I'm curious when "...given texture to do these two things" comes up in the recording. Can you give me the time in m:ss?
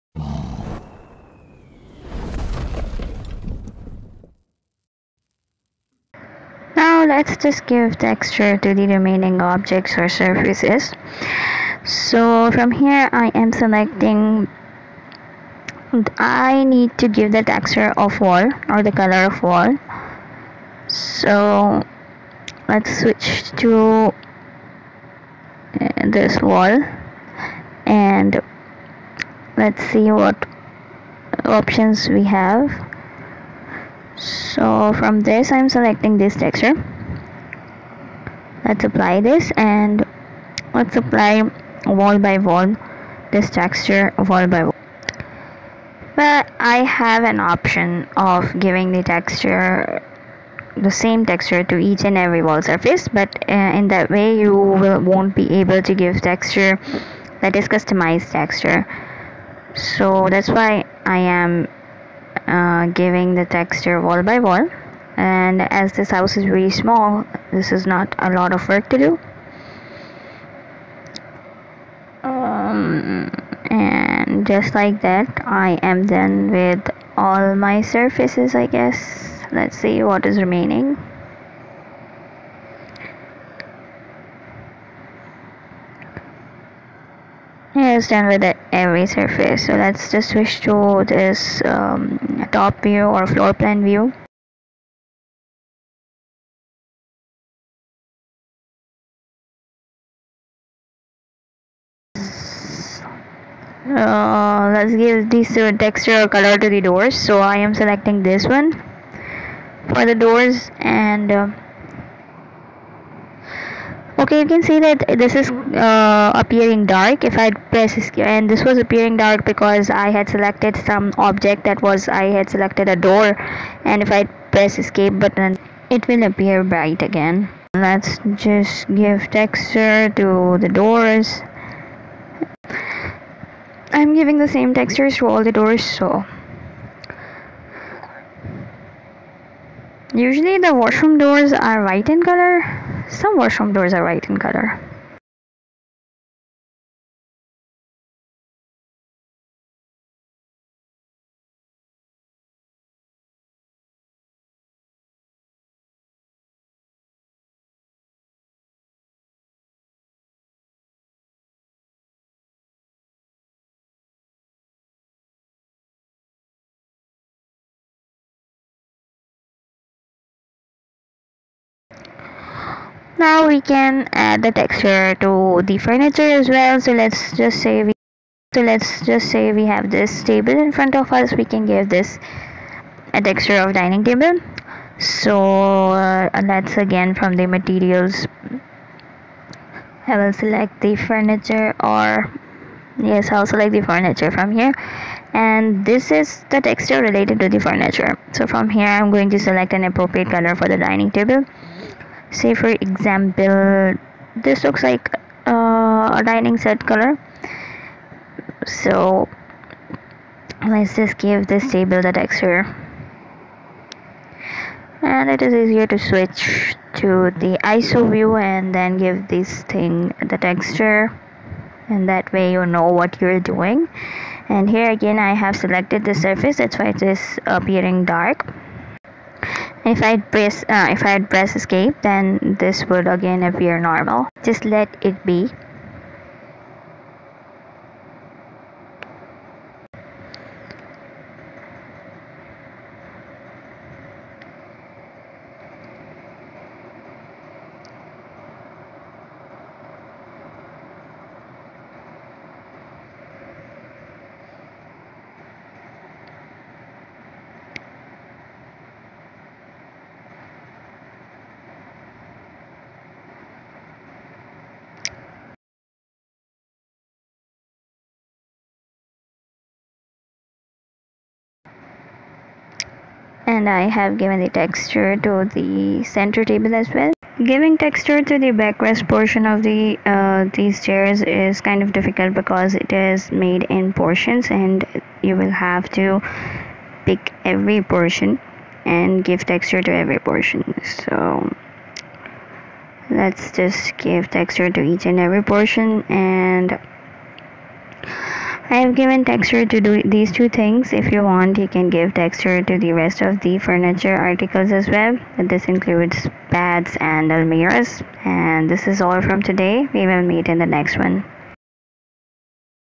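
4:58.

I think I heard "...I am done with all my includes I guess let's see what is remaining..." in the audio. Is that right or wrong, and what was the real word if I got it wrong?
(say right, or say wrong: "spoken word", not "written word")
wrong: "surfaces", not "includes".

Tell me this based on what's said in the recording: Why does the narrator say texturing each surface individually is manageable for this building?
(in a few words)
very small.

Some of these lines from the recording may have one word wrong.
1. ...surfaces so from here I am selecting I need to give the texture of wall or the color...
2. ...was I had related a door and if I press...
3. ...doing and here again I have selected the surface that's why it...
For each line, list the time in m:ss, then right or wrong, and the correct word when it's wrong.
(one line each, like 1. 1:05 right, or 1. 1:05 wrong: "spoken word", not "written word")
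1. 0:10 right
2. 2:01 wrong: "selected", not "related"
3. 3:43 right.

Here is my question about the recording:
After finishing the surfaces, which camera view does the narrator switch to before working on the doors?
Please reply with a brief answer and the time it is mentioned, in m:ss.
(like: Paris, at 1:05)
floor plan view, at 1:33.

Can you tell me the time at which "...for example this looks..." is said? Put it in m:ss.
3:22.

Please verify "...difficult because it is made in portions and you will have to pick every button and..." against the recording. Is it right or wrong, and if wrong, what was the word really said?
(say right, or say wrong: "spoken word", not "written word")
wrong: "portion", not "button".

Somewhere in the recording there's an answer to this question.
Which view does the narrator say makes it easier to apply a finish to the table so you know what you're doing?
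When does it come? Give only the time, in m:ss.
3:37.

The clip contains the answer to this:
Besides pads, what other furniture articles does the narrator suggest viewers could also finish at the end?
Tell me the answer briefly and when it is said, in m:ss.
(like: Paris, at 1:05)
almirahs, at 5:07.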